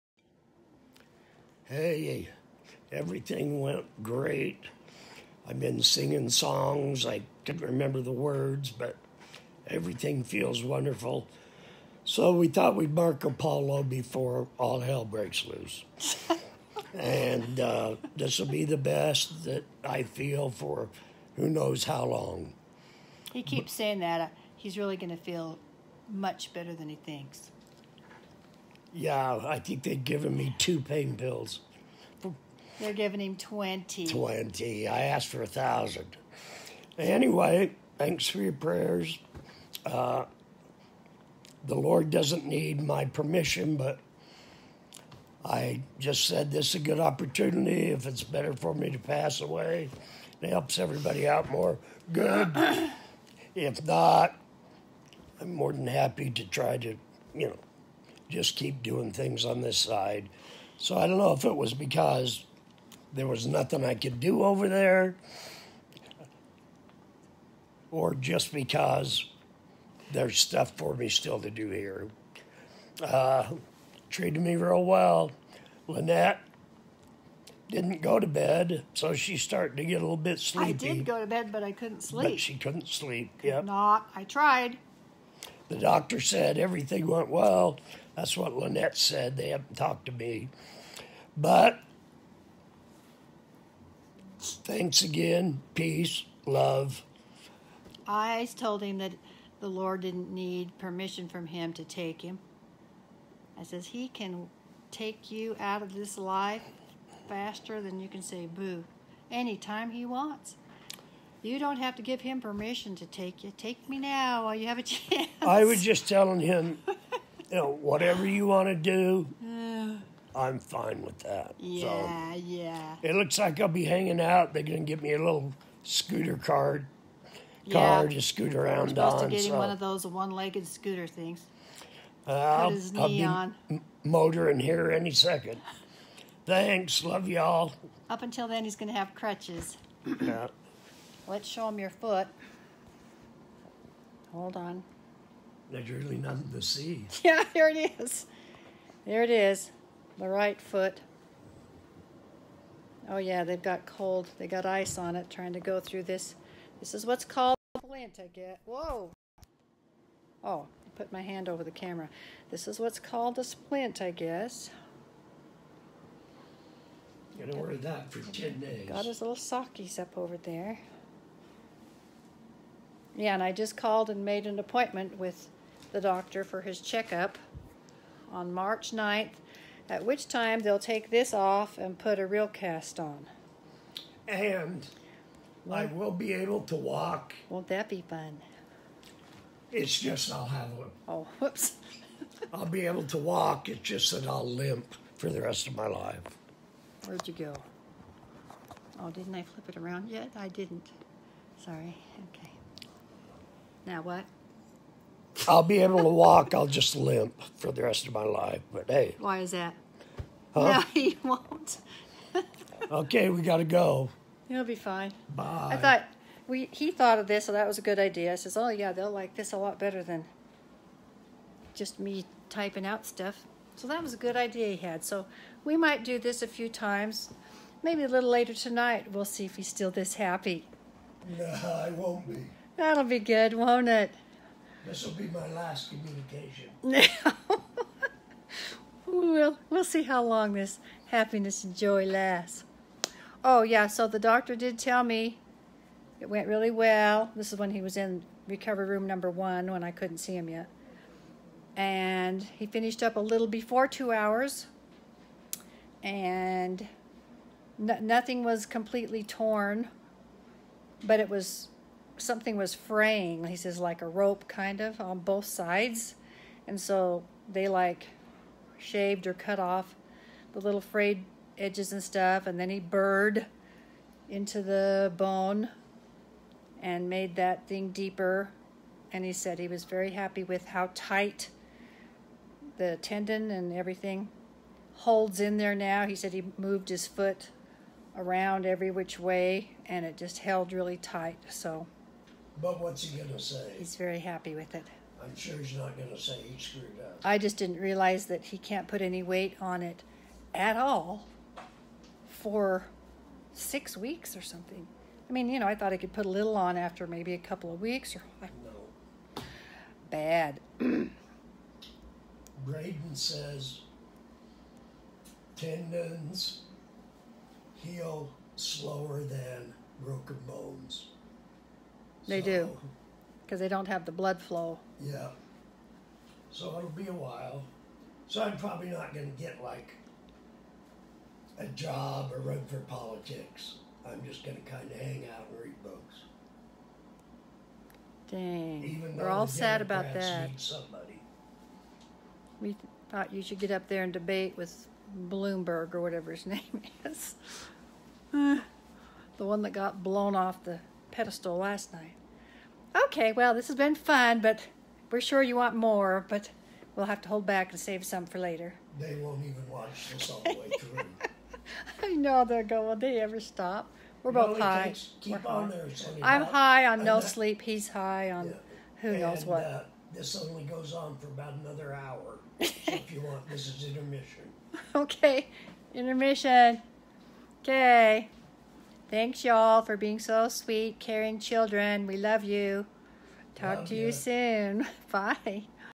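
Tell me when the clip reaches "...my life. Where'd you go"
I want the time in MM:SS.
03:15.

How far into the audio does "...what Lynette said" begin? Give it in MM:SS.
01:28.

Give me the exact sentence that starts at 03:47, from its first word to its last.
Maybe a little later tonight, we'll see if he's still this happy.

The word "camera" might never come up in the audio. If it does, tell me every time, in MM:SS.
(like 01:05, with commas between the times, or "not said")
02:41.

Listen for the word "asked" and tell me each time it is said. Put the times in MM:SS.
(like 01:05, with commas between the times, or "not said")
00:35.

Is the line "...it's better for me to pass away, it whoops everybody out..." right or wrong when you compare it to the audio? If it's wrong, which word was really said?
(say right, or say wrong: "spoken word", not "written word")
wrong: "helps", not "whoops".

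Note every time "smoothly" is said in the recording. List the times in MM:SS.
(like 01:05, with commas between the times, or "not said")
not said.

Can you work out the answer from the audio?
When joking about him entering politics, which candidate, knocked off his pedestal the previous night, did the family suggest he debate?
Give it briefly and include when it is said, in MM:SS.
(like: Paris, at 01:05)
Bloomberg, at 05:45.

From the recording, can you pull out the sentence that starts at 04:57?
I just didn't realize that he can't put any weight on it at all for six weeks or something.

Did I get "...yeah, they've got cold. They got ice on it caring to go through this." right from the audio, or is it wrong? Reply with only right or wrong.
wrong.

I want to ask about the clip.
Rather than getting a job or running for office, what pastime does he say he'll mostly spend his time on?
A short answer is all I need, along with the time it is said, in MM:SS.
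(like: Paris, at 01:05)
Read books, at 05:35.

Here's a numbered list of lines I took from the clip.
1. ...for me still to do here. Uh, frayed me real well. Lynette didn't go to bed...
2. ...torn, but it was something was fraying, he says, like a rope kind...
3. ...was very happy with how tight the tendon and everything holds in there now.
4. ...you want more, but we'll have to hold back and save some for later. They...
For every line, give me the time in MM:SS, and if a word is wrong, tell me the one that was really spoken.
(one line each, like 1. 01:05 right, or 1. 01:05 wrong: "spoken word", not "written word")
1. 01:10 wrong: "treated", not "frayed"
2. 04:19 right
3. 04:39 right
4. 05:55 right.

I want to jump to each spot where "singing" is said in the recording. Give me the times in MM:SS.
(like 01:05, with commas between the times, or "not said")
00:05.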